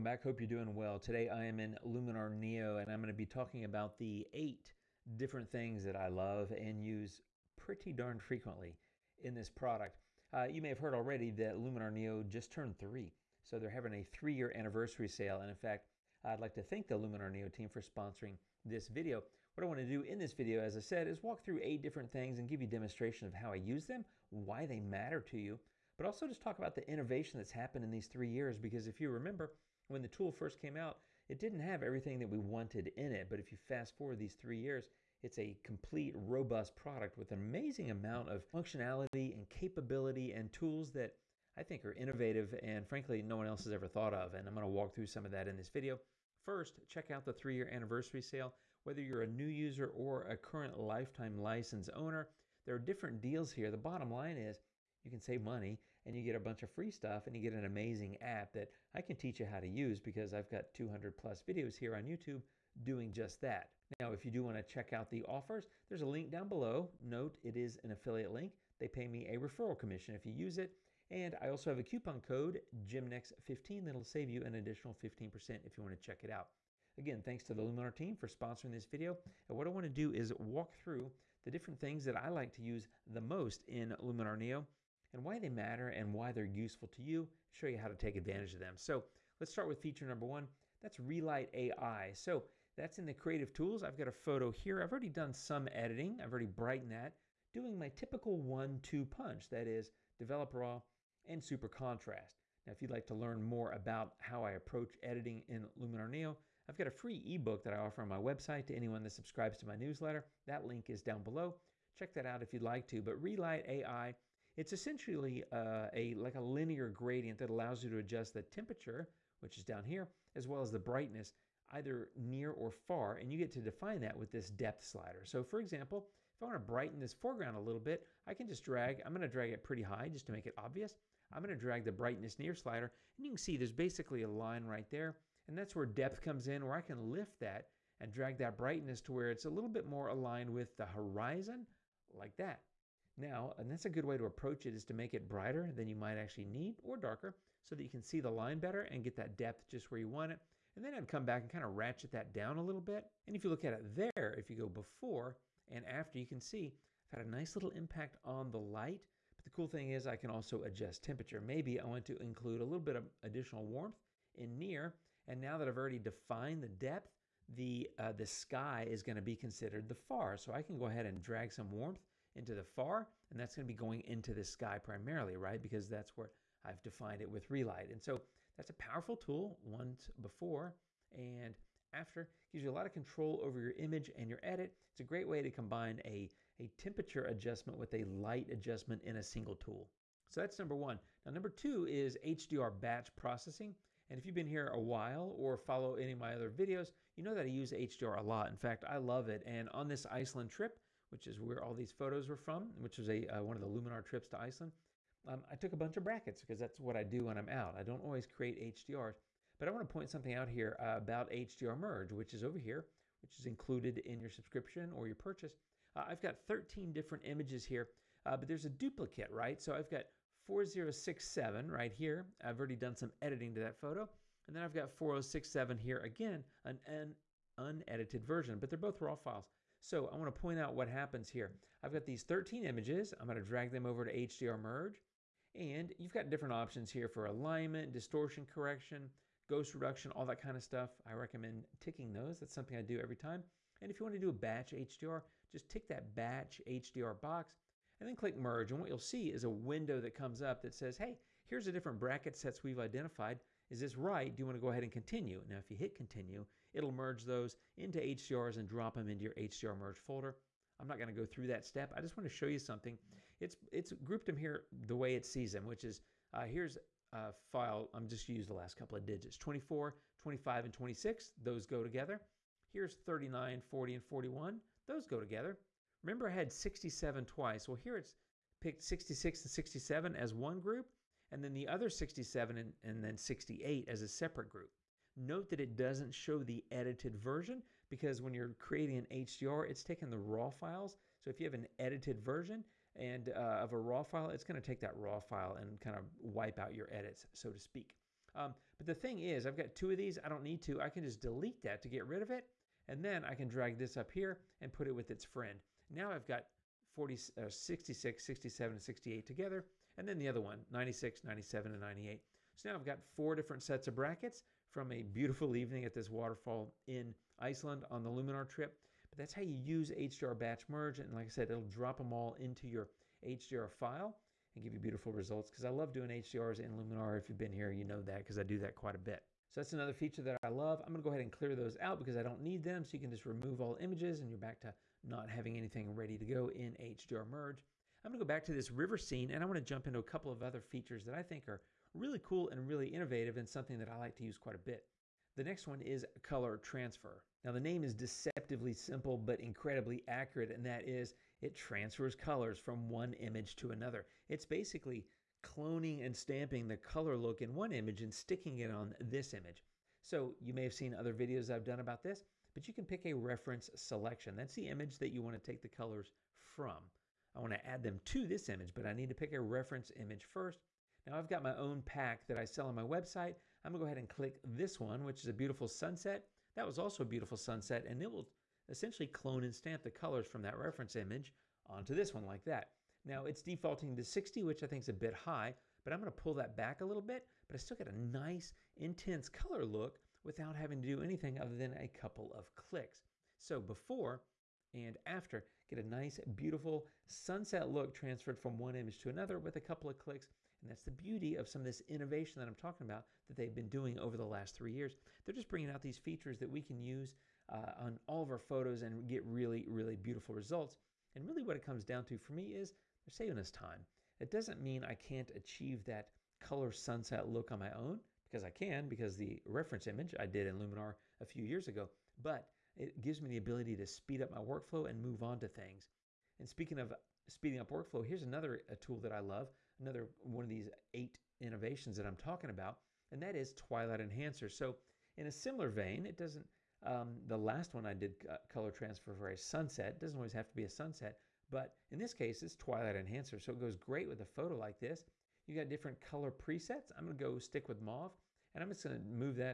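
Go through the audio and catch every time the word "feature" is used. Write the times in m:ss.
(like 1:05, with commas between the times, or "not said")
1:29, 5:29, 5:40, 6:45.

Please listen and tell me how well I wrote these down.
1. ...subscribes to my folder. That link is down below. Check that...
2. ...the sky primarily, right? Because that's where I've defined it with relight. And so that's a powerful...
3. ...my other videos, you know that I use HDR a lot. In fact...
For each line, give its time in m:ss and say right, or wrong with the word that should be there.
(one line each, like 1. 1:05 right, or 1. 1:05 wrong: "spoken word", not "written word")
1. 1:49 wrong: "newsletter", not "folder"
2. 2:54 right
3. 3:16 right.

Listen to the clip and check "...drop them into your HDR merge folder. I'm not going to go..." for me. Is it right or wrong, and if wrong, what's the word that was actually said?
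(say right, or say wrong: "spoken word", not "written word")
right.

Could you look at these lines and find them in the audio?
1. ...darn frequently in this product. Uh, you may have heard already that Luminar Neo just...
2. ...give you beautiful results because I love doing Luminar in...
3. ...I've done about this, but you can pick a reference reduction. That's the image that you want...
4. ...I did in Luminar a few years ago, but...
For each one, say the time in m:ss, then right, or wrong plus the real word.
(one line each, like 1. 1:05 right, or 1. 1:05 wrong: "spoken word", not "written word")
1. 0:07 right
2. 5:24 wrong: "HDRs", not "Luminar"
3. 6:01 wrong: "selection", not "reduction"
4. 7:00 right.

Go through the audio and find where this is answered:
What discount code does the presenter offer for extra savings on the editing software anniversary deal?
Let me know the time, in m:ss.
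1:12.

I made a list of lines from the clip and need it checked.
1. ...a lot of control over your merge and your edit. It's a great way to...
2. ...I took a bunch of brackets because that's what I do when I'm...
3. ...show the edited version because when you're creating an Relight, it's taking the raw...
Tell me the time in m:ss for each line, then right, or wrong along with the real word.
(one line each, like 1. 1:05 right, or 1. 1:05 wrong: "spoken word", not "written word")
1. 3:02 wrong: "image", not "merge"
2. 3:25 right
3. 4:46 wrong: "HDR", not "Relight".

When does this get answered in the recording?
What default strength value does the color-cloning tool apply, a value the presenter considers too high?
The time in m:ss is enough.
6:24.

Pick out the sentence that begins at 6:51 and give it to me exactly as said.
And really what it comes down to for me is they're saving us time.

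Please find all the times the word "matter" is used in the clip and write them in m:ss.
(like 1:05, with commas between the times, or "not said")
0:24, 1:25.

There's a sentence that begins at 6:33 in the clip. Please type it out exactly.
So before and after, get a nice beautiful sunset look transferred from one image to another with a couple of clicks.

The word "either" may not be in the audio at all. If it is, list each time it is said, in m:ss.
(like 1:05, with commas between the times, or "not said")
2:01.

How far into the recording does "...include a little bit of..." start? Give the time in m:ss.
2:42.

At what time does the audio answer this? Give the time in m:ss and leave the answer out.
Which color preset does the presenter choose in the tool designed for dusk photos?
7:27.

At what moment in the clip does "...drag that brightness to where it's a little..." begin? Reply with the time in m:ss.
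2:18.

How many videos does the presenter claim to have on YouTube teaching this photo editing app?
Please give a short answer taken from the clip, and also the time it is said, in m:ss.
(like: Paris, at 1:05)
200 plus, at 1:00.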